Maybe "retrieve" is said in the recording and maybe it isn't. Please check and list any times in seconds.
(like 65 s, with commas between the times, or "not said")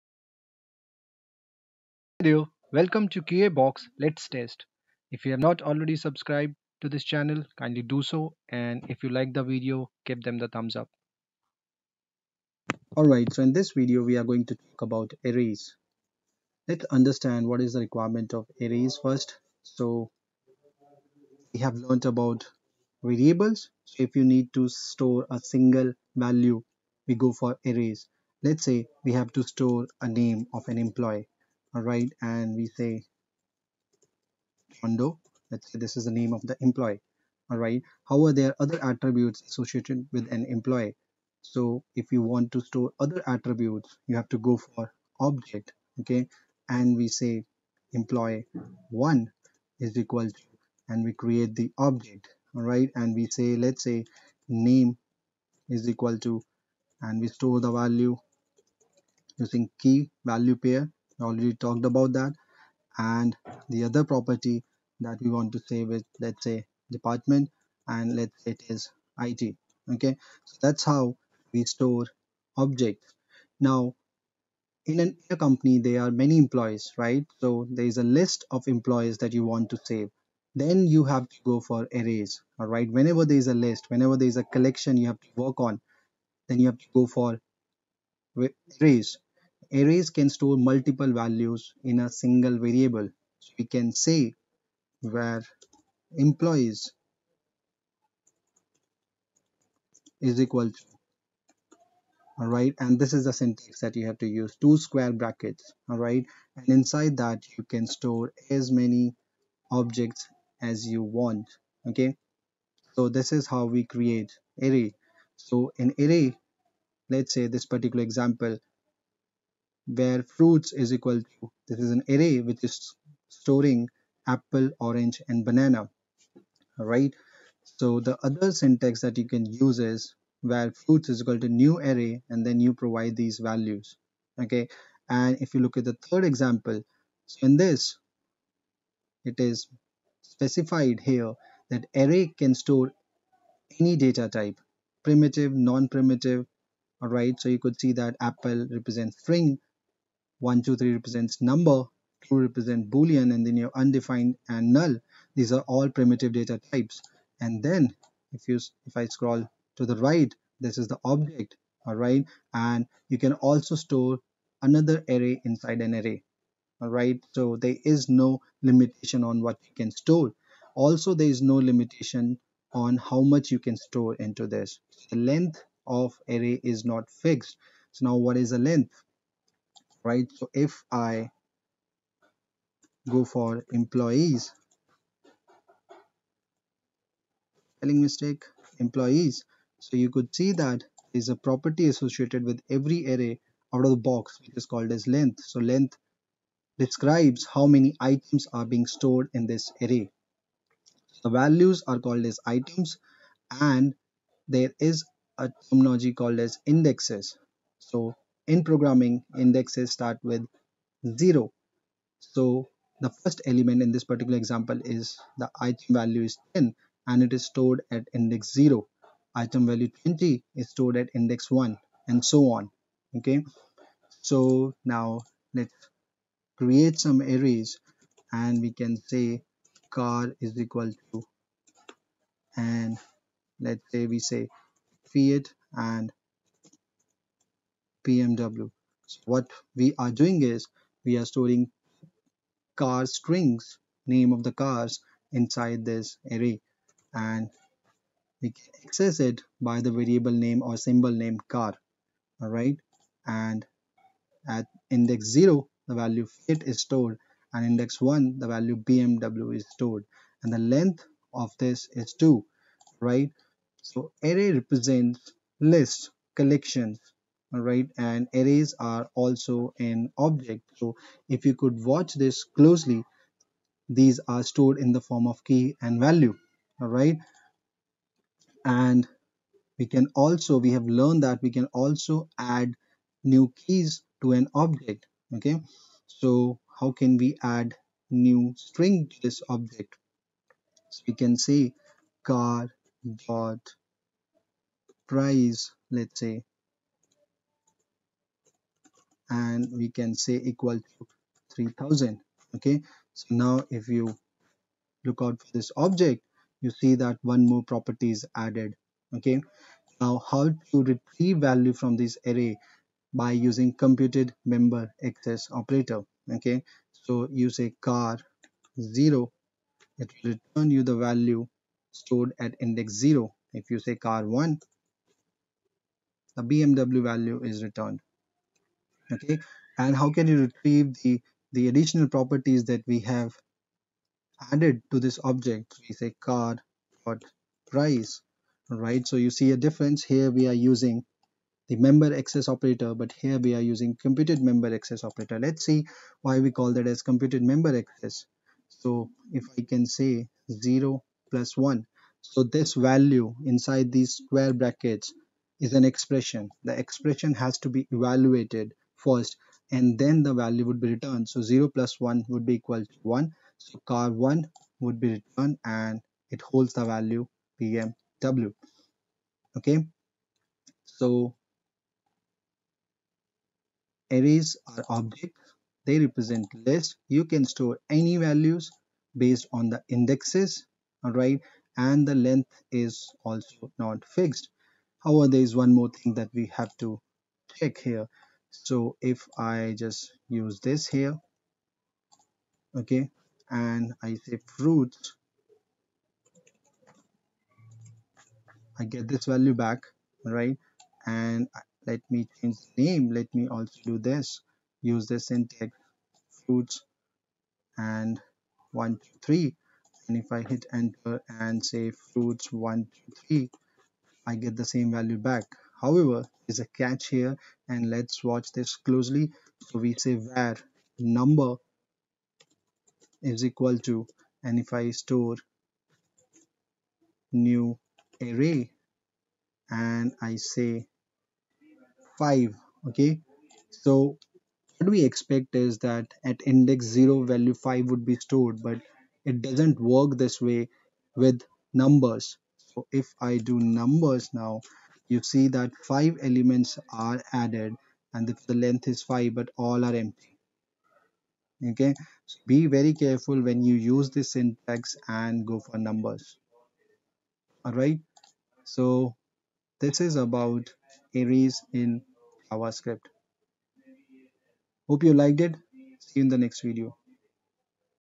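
310 s, 330 s.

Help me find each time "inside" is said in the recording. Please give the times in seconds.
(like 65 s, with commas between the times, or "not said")
106 s, 165 s, 245 s, 353 s.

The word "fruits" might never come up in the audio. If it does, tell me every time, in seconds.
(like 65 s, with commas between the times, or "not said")
120 s, 130 s, 394 s, 406 s, 411 s.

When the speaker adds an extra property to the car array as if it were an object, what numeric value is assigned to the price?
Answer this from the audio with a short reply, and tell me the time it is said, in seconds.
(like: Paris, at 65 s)
3000, at 301 s.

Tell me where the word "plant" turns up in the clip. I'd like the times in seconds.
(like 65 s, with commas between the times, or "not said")
not said.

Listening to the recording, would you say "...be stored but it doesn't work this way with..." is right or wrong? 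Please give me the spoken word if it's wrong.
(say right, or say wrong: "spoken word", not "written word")
right.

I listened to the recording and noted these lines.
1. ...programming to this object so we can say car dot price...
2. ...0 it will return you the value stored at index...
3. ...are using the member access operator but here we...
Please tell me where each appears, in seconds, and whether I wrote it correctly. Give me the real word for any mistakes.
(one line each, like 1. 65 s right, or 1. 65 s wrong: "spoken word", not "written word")
1. 288 s wrong: "string", not "programming"
2. 318 s right
3. 340 s right.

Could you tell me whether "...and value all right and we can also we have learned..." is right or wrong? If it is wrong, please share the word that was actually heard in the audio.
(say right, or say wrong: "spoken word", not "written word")
right.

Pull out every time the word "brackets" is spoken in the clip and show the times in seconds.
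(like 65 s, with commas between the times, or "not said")
105 s, 354 s.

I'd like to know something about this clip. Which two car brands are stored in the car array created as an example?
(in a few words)
Fiat and BMW.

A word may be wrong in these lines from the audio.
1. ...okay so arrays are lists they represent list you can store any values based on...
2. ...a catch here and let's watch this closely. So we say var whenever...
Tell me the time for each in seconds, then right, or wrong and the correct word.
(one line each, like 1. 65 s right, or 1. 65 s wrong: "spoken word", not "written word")
1. 369 s wrong: "objects", not "lists"
2. 416 s wrong: "number", not "whenever".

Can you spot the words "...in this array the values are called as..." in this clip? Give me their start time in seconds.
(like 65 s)
199 s.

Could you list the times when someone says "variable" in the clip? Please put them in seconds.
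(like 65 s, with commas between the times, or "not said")
23 s, 92 s, 249 s.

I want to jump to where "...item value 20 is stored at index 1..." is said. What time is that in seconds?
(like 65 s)
219 s.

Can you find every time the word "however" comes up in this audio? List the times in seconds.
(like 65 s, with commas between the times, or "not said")
385 s, 415 s.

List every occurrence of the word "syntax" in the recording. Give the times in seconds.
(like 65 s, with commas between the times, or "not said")
103 s, 128 s, 405 s, 454 s.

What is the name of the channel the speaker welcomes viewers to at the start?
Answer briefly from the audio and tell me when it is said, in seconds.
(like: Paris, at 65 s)
QA Box, at 3 s.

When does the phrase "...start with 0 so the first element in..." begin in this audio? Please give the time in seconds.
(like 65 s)
209 s.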